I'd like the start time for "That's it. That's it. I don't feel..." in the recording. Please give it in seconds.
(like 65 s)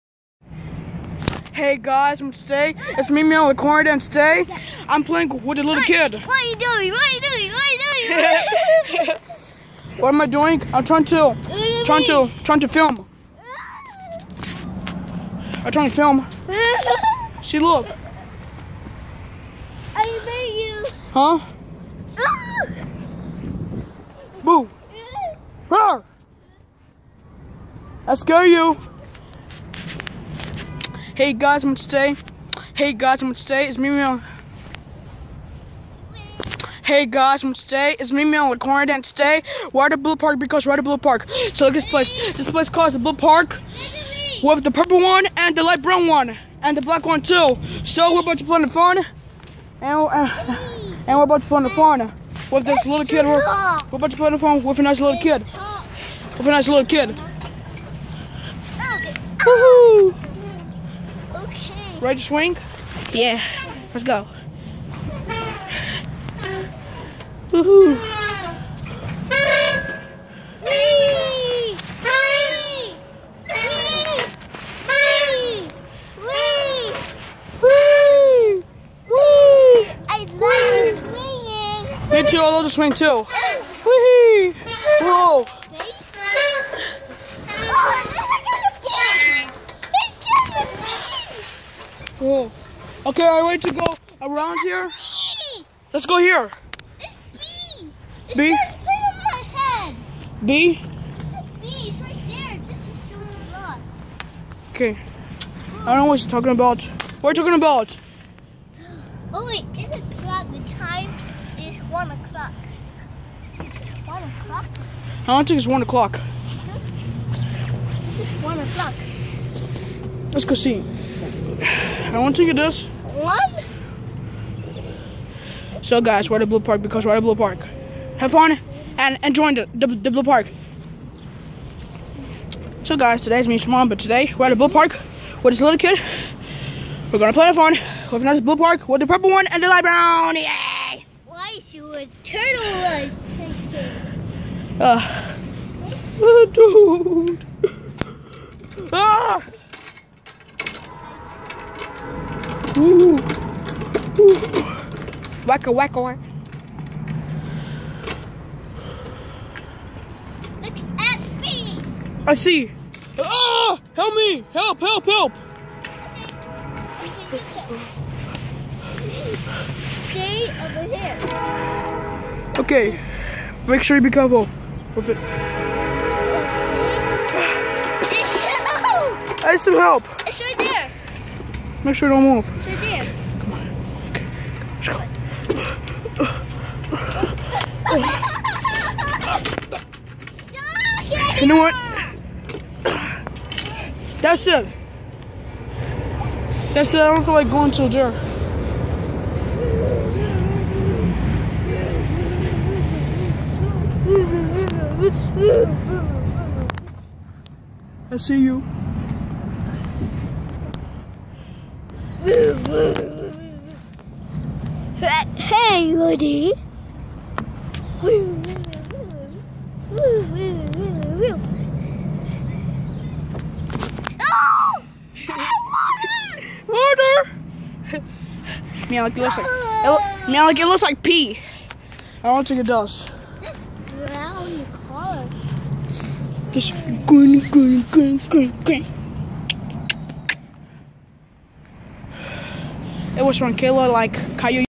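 194 s.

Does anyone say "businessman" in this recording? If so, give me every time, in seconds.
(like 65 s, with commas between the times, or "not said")
not said.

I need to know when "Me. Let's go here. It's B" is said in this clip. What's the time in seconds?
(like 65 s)
94 s.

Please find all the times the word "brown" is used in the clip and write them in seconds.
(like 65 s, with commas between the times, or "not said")
45 s, 139 s.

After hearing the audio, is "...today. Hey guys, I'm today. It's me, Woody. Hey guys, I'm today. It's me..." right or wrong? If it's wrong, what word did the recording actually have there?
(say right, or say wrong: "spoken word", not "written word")
wrong: "Meow", not "Woody".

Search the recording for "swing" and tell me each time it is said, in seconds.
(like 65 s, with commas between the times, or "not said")
62 s, 82 s.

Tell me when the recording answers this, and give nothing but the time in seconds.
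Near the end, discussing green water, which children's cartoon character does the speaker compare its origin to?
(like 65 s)
244 s.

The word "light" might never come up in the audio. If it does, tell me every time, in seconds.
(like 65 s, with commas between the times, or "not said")
45 s, 139 s.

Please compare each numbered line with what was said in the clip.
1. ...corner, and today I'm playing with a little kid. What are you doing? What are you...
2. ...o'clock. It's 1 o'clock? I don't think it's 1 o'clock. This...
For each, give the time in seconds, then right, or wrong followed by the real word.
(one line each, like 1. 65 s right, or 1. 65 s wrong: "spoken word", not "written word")
1. 3 s right
2. 112 s right.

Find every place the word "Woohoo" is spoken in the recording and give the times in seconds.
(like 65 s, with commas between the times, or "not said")
59 s, 67 s.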